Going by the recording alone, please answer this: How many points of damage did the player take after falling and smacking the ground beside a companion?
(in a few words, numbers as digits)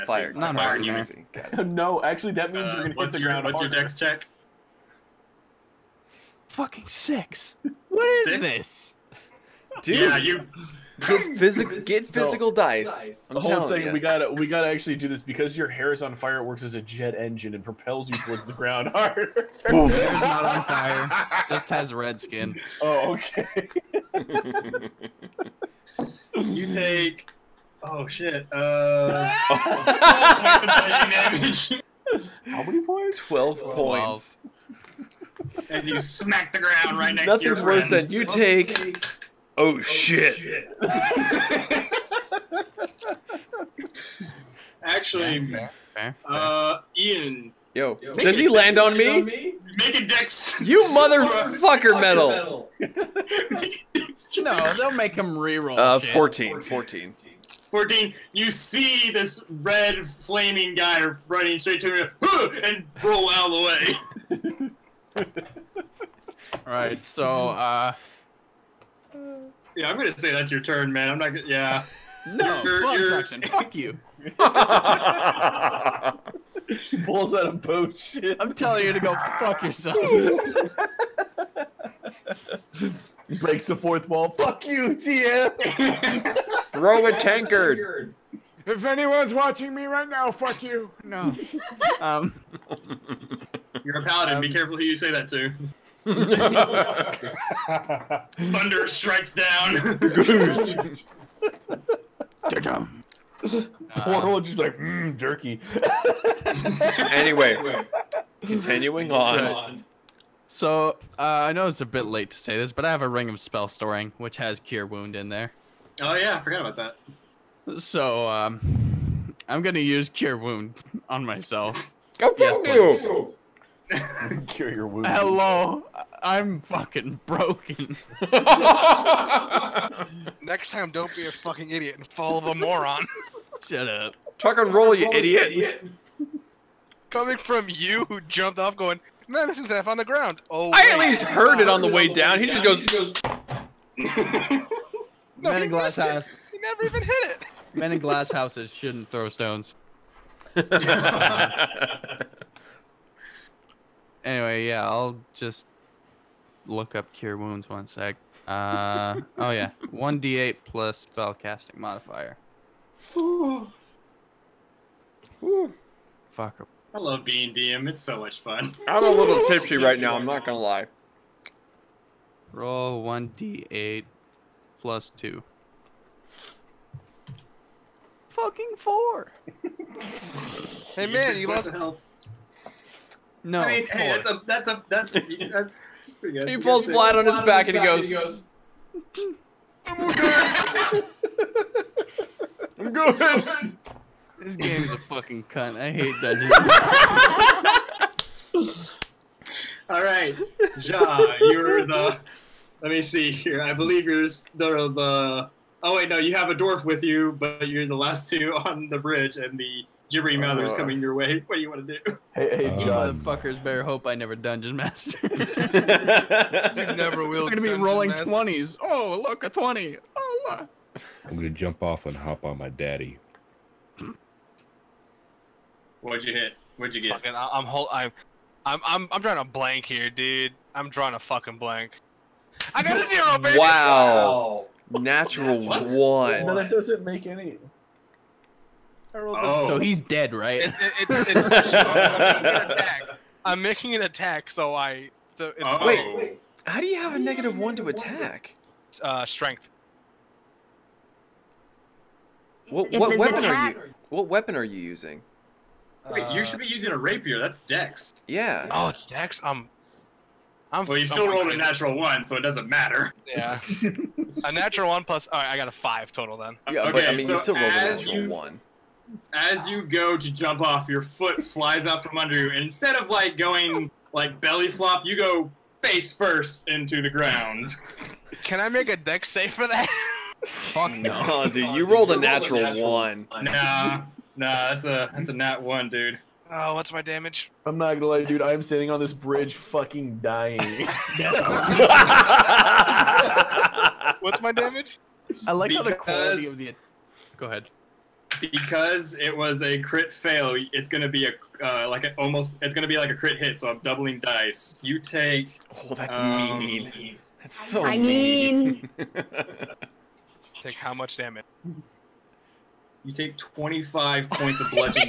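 12.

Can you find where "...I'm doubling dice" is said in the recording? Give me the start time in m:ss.
5:03.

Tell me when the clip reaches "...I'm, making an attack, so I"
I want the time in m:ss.
4:03.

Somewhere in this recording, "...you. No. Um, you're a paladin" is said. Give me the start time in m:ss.
1:30.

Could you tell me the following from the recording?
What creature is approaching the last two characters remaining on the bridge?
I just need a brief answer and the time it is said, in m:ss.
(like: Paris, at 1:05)
gibbering mouther, at 3:30.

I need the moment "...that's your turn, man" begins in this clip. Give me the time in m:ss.
1:10.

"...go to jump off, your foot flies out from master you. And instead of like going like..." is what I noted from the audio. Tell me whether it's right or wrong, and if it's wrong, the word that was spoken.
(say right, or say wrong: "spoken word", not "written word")
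wrong: "under", not "master".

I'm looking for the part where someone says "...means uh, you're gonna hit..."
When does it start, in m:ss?
0:02.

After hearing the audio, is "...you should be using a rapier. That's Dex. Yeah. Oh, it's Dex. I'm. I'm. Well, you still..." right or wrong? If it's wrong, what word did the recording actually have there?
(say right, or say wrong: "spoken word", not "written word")
right.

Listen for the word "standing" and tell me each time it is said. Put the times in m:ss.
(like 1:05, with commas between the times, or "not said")
4:48.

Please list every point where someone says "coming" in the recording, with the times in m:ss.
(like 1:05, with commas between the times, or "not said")
2:17, 3:30.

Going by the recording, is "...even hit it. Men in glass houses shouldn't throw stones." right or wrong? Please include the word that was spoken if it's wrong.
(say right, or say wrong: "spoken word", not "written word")
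right.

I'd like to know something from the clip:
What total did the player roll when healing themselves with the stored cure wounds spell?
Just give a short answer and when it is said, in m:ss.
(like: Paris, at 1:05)
4, at 2:58.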